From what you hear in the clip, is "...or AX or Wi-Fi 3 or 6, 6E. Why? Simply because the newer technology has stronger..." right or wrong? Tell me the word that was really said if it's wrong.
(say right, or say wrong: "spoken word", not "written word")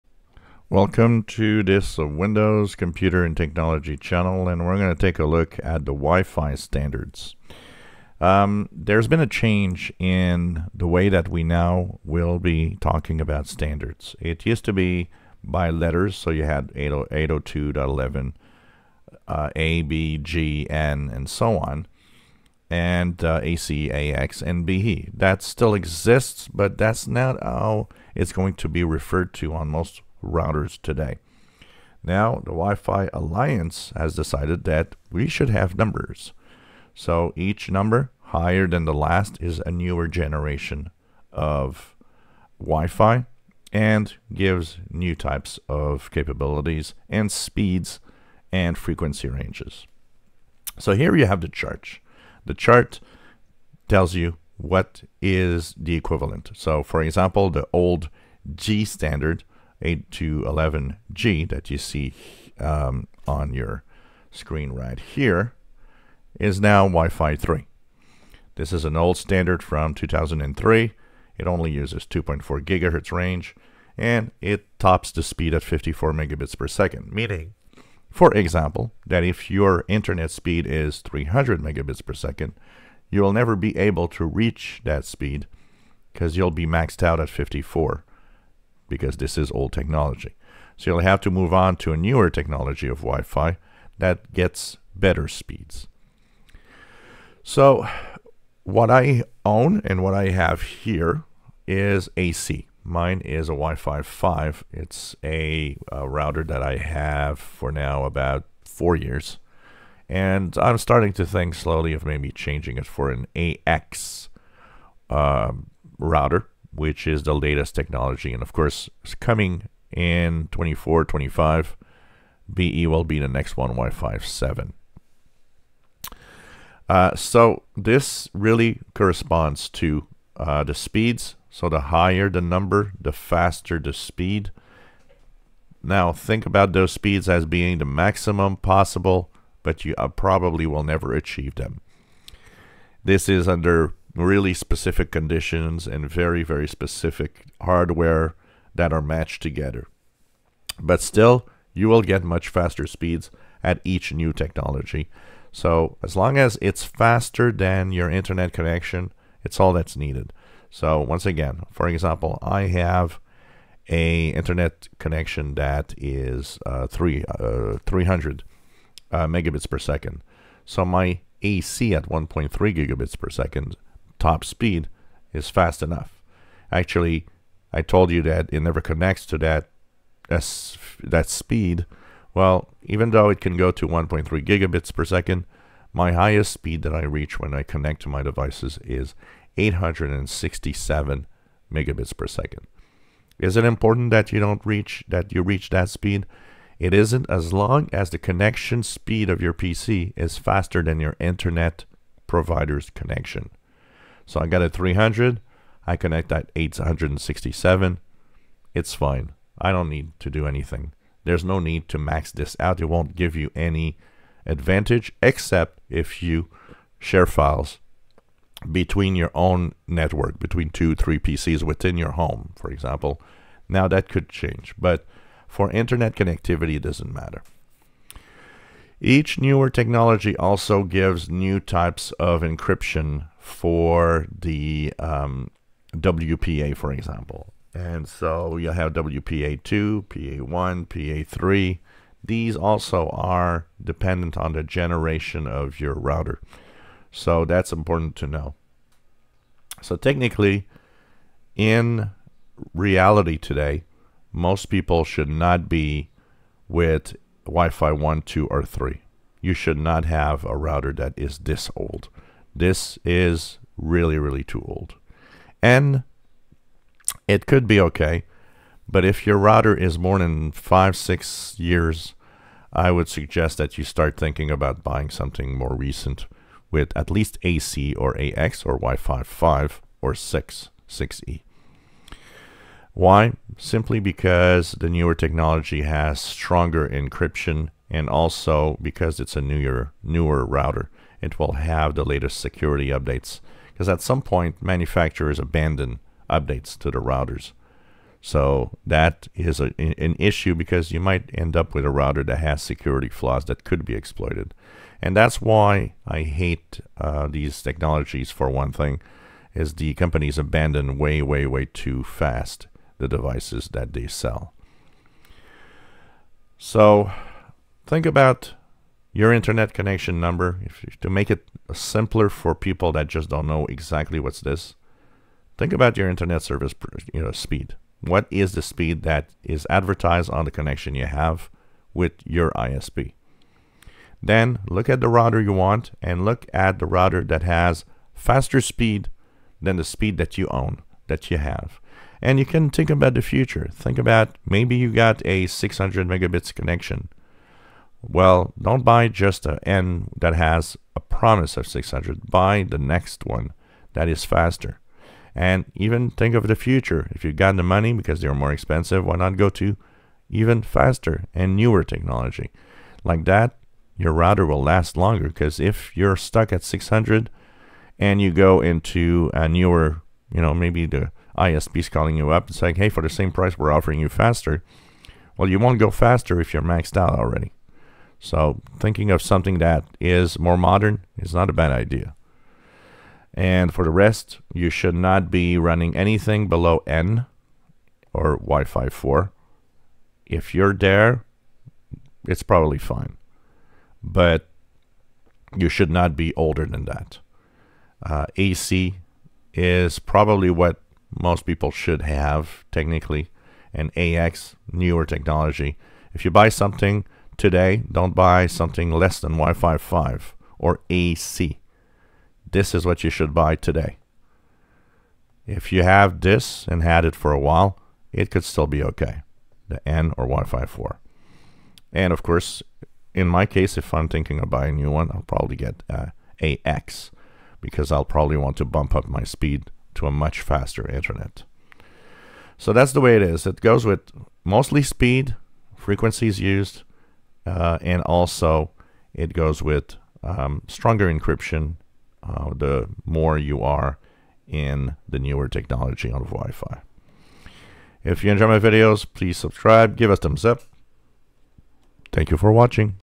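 wrong: "5", not "3".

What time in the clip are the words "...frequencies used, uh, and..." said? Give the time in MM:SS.
07:15.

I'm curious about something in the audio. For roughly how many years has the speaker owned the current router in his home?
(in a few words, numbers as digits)
4 years.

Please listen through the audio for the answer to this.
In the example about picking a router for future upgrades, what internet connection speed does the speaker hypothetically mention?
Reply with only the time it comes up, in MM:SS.
05:45.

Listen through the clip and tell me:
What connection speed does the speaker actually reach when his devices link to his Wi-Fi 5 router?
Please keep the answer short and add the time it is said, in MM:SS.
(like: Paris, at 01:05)
867 megabits per second, at 03:09.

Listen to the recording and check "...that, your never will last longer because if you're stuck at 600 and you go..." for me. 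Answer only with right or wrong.
wrong.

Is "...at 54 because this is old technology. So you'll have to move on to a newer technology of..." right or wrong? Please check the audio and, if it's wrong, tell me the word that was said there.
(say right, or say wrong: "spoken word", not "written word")
right.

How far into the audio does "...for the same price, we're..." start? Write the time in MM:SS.
06:12.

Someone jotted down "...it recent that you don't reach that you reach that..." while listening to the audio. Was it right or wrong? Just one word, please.
wrong.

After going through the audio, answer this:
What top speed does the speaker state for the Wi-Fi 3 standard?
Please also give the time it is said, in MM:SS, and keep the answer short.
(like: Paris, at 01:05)
54 megabits per second, at 01:15.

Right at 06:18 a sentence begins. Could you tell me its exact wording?
So thinking of something that is more modern is not a bad idea.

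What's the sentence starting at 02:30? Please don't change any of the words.
But still, you will get much faster speeds at each new technology.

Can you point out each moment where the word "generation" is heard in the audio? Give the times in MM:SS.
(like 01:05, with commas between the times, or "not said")
00:40, 04:04.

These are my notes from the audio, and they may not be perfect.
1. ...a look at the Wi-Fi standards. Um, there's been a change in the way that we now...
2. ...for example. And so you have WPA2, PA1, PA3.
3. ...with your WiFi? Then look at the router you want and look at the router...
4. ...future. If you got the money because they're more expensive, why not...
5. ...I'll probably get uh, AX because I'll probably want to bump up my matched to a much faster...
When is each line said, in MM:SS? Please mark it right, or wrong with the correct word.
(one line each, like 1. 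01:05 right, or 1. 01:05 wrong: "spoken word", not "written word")
1. 00:05 right
2. 03:56 right
3. 05:31 wrong: "ISP", not "WiFi"
4. 05:56 right
5. 07:05 wrong: "speed", not "matched".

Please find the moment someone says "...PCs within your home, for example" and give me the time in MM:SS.
03:41.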